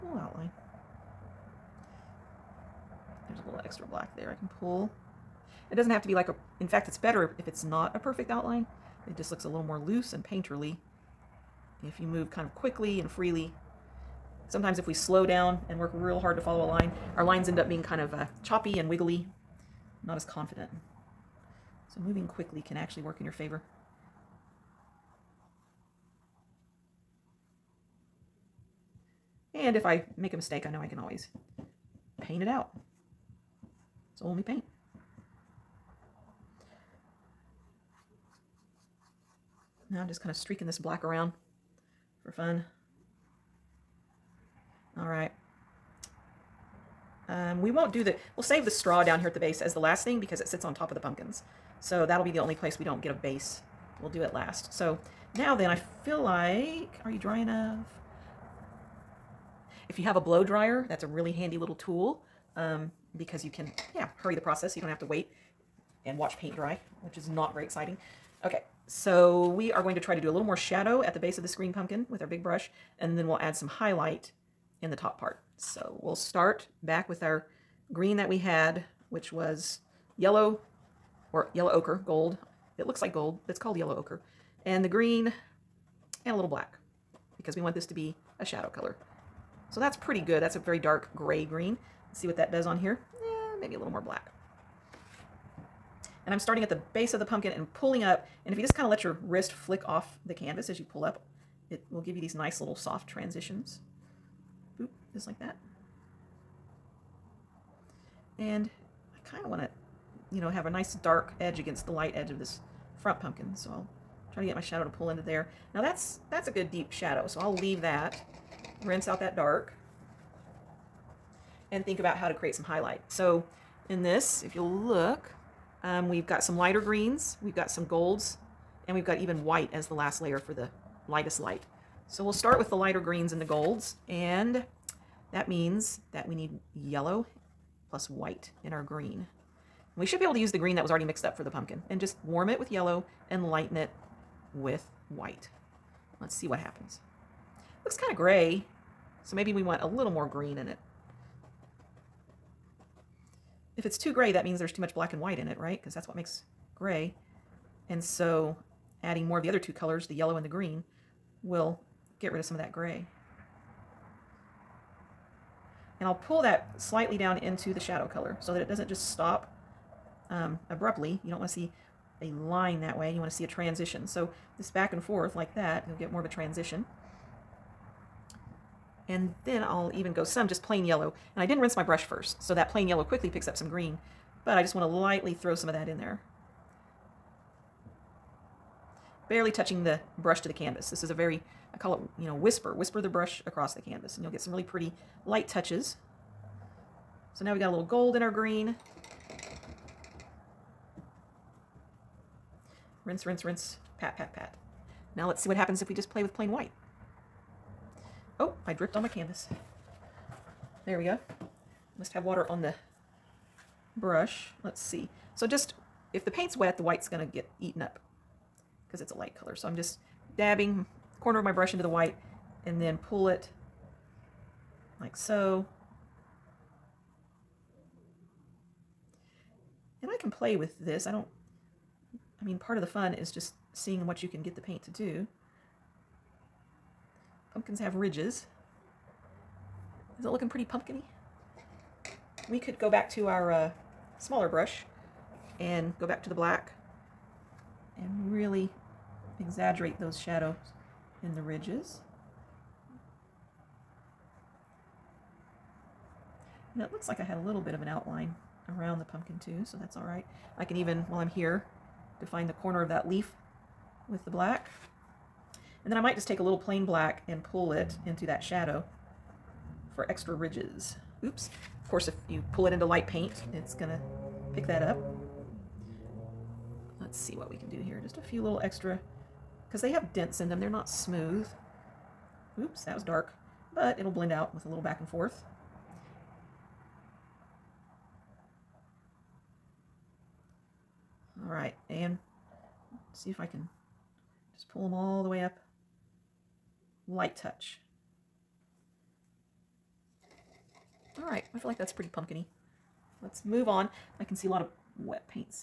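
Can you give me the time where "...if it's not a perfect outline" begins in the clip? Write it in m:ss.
0:07.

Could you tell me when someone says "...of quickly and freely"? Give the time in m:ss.
0:12.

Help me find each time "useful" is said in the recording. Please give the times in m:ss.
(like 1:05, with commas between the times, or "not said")
not said.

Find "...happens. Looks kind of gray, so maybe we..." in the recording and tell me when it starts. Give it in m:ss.
2:26.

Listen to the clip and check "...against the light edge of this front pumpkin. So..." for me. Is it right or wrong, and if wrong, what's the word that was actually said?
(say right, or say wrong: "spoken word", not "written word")
right.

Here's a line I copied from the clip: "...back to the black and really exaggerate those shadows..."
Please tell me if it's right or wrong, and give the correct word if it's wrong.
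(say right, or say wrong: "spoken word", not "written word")
right.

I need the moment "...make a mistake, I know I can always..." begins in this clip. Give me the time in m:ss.
0:30.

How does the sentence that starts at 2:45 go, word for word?
And I'll pull that slightly down into the shadow color so that it doesn't just stop um, abruptly.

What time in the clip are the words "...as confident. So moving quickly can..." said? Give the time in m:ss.
0:20.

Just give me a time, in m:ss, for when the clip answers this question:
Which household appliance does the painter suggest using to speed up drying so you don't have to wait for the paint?
1:00.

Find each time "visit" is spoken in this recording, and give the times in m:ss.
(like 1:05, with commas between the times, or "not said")
not said.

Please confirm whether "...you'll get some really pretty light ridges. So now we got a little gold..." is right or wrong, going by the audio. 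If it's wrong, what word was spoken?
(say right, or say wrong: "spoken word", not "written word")
wrong: "touches", not "ridges".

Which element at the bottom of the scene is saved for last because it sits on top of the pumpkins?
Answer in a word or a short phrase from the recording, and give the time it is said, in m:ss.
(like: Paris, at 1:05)
The straw, at 0:48.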